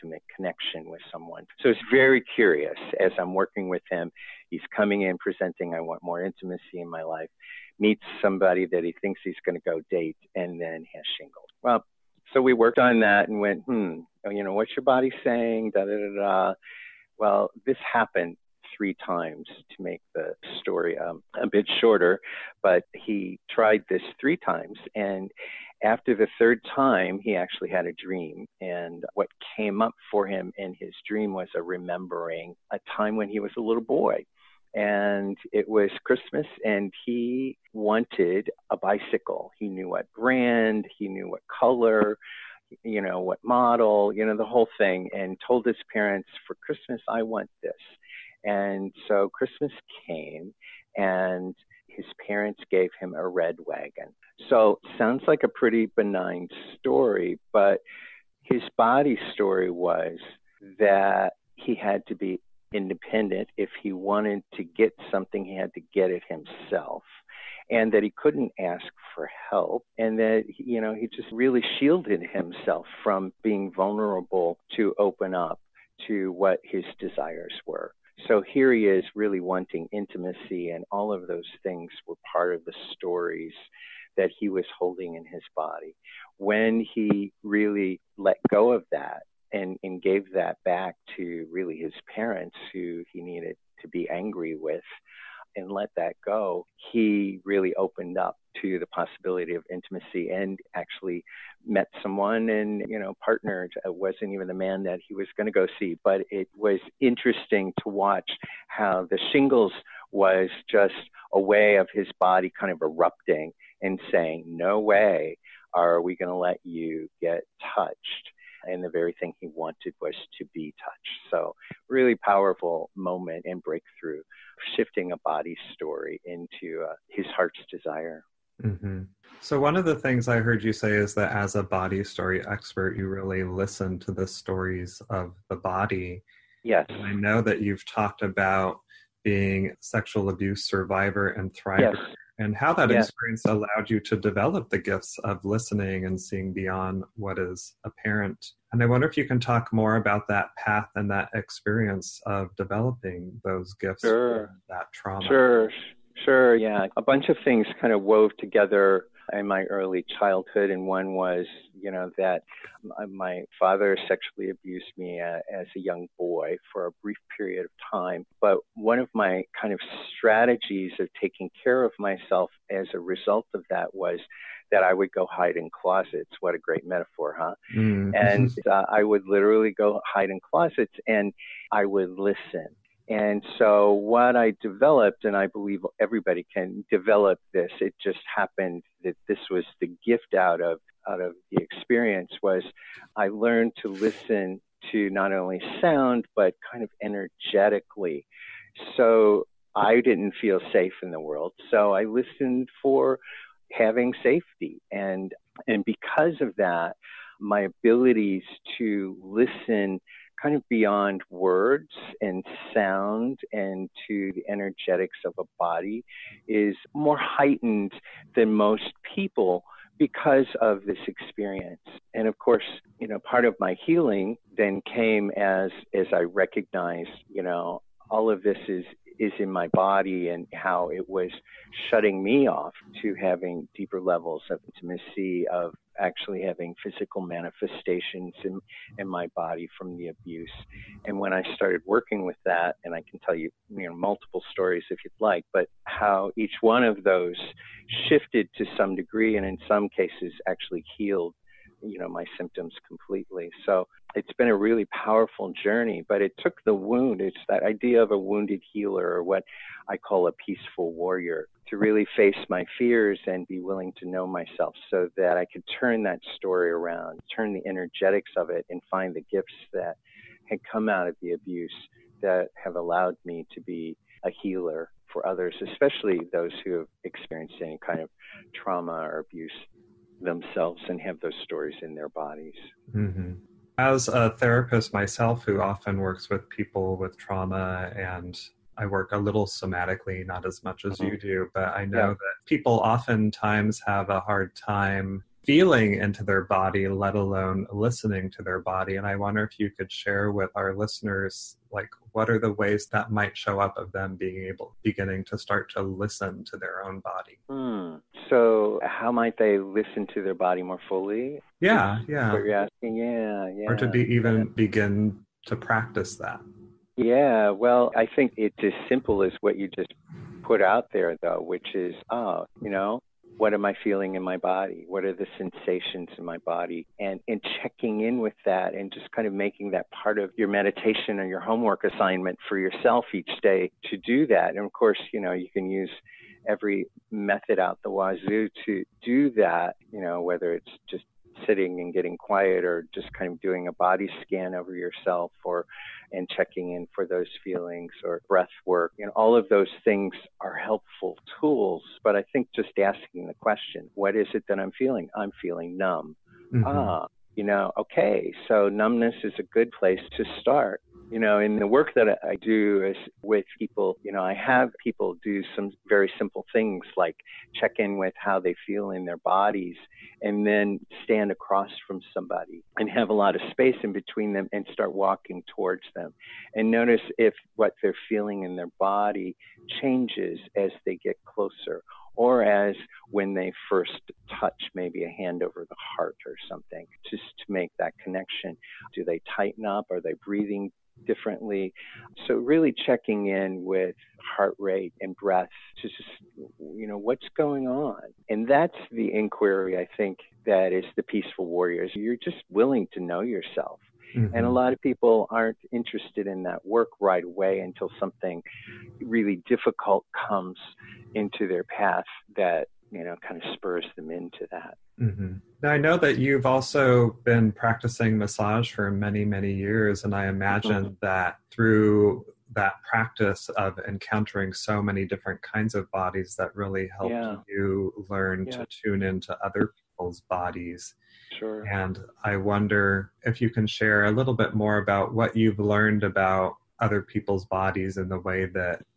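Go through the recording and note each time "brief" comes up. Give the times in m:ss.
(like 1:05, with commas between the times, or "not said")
2:47.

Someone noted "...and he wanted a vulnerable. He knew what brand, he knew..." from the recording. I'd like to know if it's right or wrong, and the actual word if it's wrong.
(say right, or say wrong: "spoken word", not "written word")
wrong: "bicycle", not "vulnerable".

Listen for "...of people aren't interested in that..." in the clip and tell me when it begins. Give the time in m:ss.
6:44.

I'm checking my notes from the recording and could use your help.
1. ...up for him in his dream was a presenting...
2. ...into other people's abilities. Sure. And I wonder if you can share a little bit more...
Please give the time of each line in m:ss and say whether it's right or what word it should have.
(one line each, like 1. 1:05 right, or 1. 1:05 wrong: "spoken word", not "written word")
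1. 0:29 wrong: "remembering", not "presenting"
2. 7:09 wrong: "bodies", not "abilities".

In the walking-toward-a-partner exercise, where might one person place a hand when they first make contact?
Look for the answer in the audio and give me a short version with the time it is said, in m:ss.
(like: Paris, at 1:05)
over the heart, at 6:25.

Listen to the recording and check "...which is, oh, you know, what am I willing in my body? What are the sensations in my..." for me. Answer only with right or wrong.
wrong.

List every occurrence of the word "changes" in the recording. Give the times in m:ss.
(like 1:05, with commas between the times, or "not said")
6:19.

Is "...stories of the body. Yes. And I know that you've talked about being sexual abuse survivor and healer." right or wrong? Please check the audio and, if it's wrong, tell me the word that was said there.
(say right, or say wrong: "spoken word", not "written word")
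wrong: "thriver", not "healer".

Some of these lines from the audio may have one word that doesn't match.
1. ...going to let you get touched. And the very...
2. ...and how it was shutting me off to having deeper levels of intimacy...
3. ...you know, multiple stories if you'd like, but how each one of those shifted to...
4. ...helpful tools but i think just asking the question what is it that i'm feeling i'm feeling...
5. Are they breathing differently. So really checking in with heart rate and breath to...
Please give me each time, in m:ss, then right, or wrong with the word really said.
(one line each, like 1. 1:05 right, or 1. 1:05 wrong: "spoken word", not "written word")
1. 1:56 right
2. 3:50 right
3. 4:03 right
4. 5:50 right
5. 6:29 right.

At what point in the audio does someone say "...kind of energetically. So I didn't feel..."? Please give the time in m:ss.
3:16.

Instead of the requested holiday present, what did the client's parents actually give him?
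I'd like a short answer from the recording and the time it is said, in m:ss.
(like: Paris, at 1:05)
a red wagon, at 0:53.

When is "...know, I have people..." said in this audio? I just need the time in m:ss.
6:04.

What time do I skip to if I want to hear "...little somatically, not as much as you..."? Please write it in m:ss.
4:49.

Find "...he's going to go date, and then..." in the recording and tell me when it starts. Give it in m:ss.
0:09.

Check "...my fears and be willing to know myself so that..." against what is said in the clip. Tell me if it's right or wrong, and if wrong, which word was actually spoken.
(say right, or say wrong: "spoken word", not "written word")
right.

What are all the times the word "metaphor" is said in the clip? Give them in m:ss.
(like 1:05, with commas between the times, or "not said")
2:56.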